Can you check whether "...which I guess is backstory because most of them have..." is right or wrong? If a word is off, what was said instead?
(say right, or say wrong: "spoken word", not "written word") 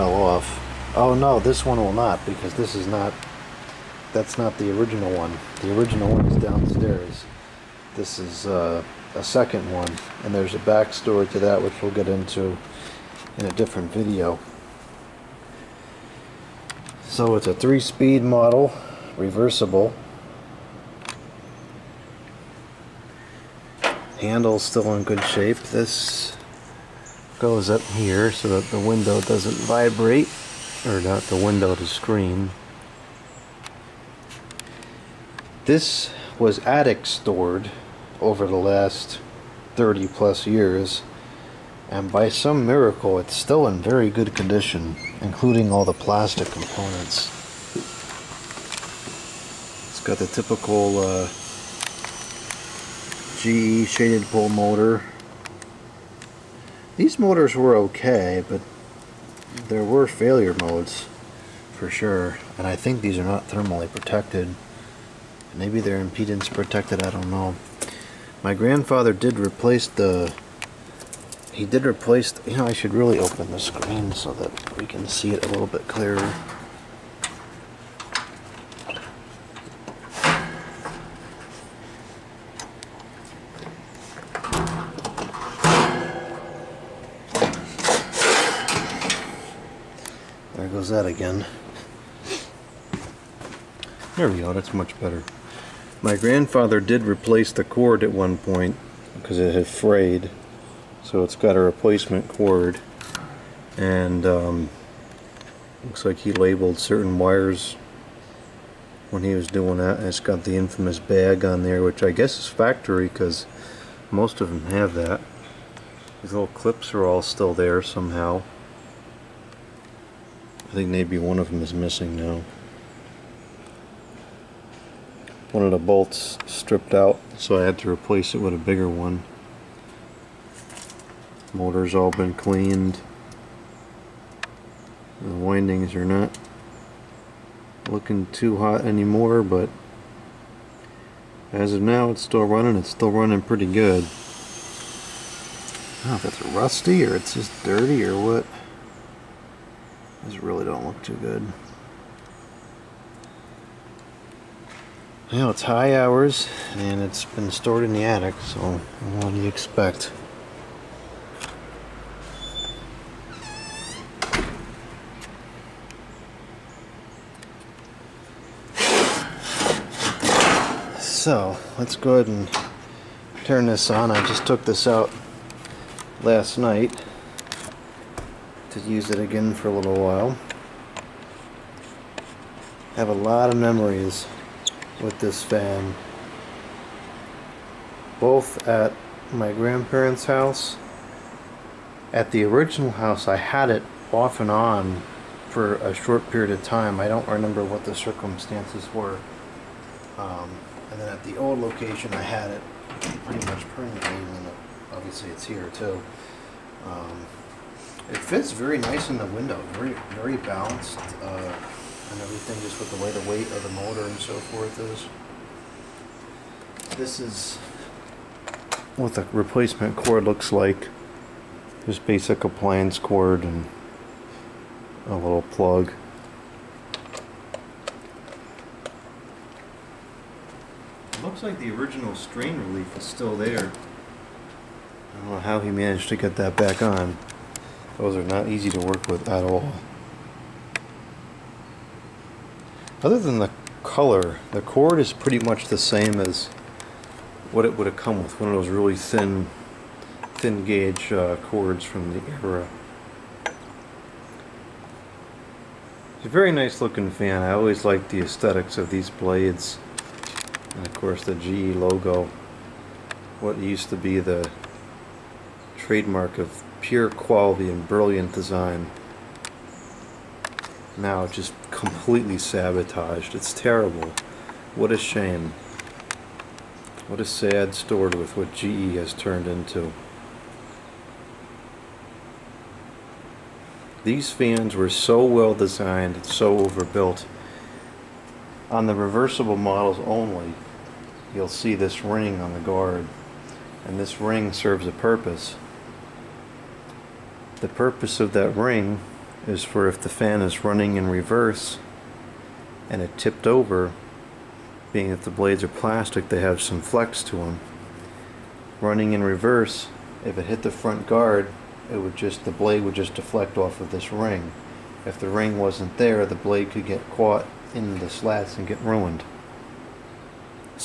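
wrong: "factory", not "backstory".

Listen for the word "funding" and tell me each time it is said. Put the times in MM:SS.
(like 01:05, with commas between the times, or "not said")
not said.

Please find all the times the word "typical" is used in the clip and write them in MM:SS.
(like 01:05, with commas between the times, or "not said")
00:50.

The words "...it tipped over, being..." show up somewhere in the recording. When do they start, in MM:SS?
05:02.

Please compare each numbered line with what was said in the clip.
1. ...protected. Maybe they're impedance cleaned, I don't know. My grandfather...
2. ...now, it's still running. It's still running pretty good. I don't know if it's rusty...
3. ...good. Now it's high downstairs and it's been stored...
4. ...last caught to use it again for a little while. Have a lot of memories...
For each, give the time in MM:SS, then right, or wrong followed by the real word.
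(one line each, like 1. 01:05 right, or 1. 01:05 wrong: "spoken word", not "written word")
1. 01:03 wrong: "protected", not "cleaned"
2. 02:21 right
3. 02:31 wrong: "hours", not "downstairs"
4. 02:56 wrong: "night", not "caught".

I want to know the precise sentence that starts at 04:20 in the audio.
And of course the GE logo, what used to be the trademark of pure quality and brilliant design.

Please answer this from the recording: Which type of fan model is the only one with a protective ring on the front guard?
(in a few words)
Reversible models.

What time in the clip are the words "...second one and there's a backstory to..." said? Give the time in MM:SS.
00:09.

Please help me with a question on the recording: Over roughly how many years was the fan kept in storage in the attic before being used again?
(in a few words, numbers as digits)
30 plus years.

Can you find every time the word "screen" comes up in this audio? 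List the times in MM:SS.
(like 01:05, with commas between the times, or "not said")
00:31, 01:13.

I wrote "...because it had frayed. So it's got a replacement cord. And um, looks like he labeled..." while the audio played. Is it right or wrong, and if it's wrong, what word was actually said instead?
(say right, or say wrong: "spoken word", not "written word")
right.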